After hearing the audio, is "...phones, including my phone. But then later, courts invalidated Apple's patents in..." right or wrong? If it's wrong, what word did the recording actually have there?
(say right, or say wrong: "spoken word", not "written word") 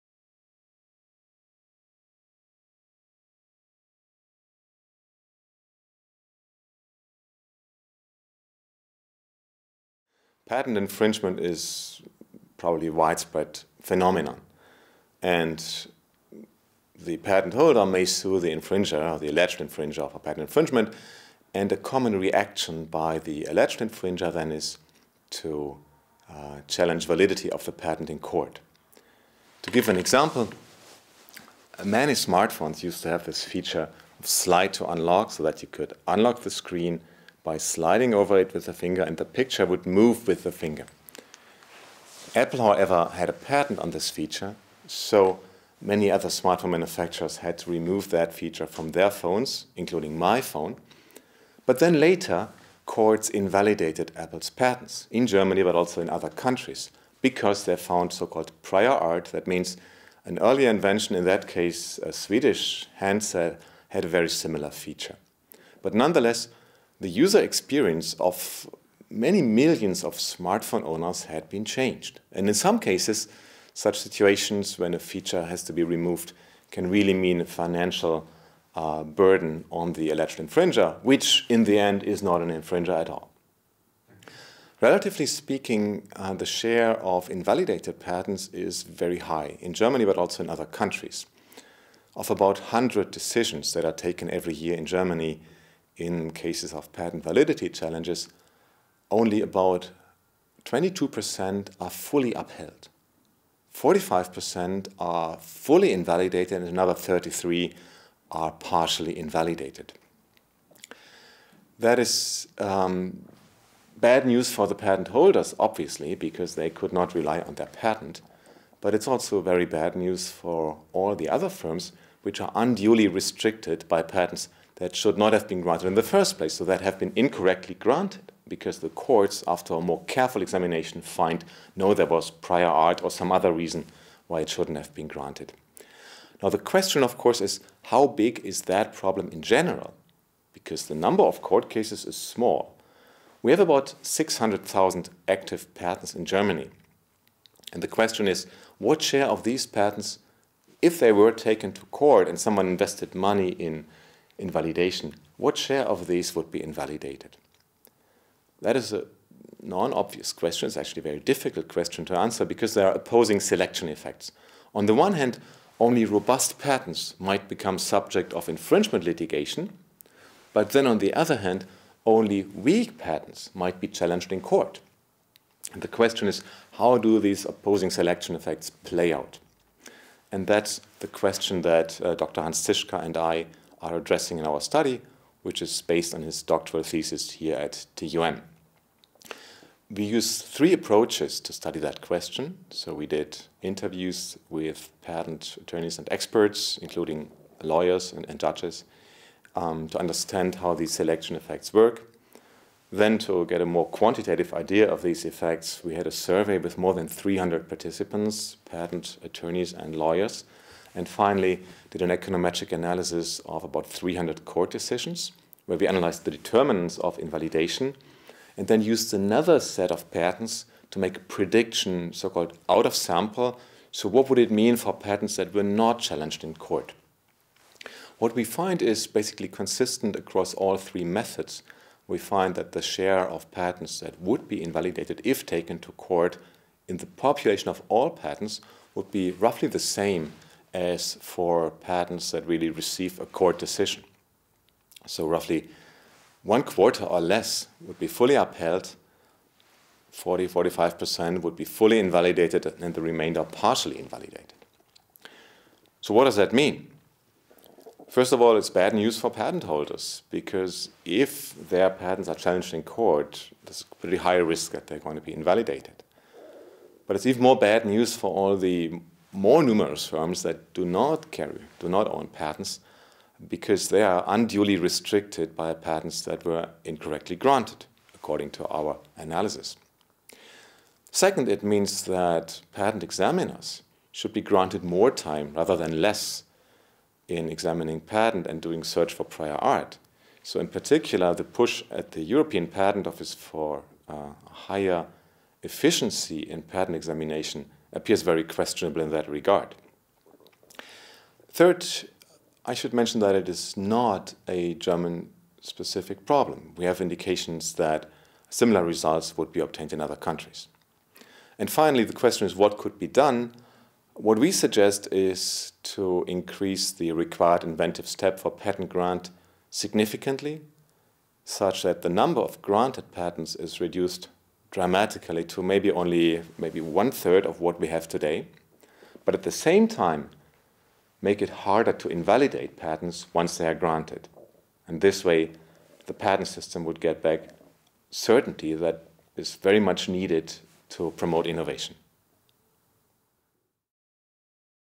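right.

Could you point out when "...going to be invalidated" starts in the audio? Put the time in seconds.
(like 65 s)
264 s.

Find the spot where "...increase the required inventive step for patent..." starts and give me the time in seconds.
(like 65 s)
316 s.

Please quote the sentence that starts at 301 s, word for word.
Third, I should mention that it is not a German specific problem.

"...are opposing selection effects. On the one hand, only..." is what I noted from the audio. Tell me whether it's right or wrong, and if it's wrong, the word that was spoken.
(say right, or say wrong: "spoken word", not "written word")
right.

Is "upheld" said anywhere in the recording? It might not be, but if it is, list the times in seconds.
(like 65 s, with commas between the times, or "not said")
102 s, 248 s.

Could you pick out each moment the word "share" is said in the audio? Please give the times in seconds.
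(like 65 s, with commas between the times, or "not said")
86 s, 149 s, 155 s, 232 s.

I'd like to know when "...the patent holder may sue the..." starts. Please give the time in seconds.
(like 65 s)
16 s.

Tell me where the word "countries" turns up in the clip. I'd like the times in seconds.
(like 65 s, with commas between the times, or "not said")
56 s, 90 s, 310 s.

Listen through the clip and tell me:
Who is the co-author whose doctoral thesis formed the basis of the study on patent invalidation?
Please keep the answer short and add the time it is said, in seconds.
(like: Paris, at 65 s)
Hans Zischka, at 182 s.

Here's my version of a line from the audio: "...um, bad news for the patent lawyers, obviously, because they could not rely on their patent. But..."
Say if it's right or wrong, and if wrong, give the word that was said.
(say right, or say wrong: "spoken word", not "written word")
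wrong: "holders", not "lawyers".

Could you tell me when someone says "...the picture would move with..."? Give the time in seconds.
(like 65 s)
39 s.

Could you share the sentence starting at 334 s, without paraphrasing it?
And this way, the patent system would get back certainty that is very much needed to promote innovation.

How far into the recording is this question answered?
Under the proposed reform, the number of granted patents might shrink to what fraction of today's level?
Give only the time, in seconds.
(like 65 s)
326 s.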